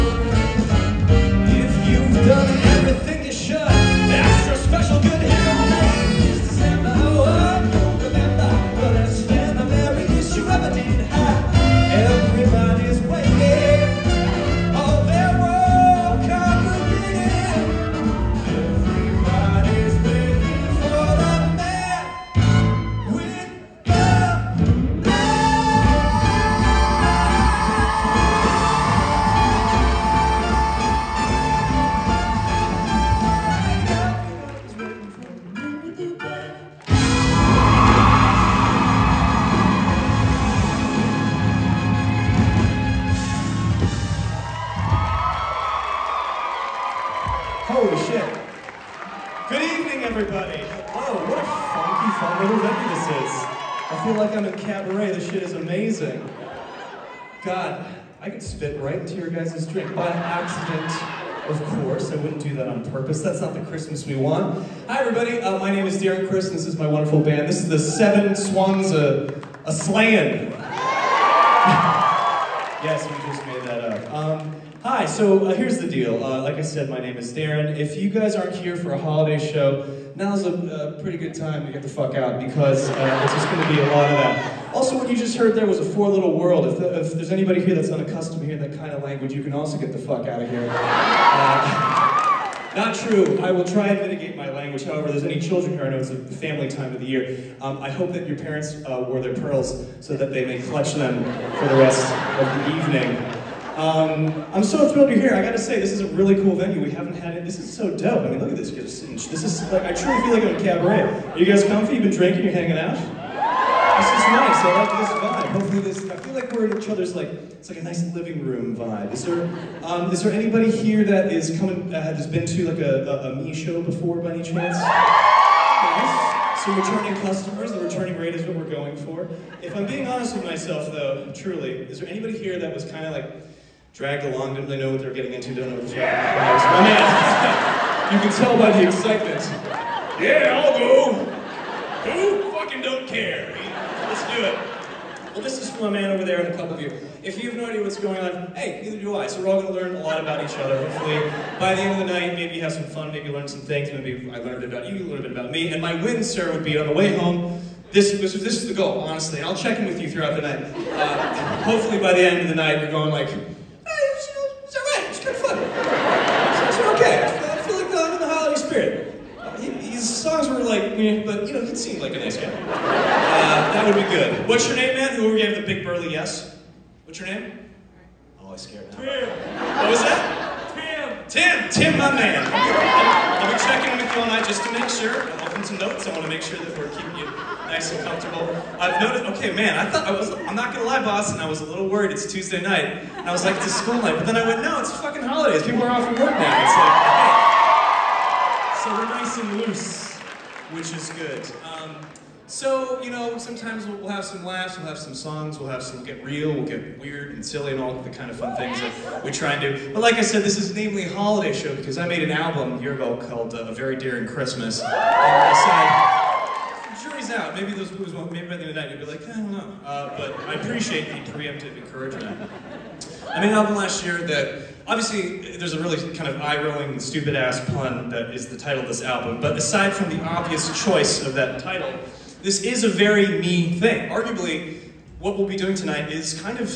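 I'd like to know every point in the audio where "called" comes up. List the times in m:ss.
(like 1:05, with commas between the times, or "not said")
3:33.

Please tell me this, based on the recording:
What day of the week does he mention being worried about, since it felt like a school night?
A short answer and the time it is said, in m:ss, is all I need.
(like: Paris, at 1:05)
Tuesday, at 3:12.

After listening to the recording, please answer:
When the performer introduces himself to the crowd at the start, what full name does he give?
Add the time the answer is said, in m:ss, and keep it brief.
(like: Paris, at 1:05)
Darren Criss, at 1:06.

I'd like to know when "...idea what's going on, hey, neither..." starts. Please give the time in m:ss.
2:27.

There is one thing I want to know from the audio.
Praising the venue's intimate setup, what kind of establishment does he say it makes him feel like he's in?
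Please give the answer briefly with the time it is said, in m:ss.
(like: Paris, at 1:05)
a cabaret, at 1:50.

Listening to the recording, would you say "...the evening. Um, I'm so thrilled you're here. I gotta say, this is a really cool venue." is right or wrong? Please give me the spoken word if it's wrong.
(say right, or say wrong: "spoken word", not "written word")
right.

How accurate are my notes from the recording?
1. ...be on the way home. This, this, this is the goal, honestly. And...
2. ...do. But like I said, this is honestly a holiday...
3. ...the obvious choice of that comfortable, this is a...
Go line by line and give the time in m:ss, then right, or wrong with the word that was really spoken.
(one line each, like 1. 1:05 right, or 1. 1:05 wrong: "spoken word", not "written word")
1. 2:36 right
2. 3:29 wrong: "namely", not "honestly"
3. 3:50 wrong: "title", not "comfortable".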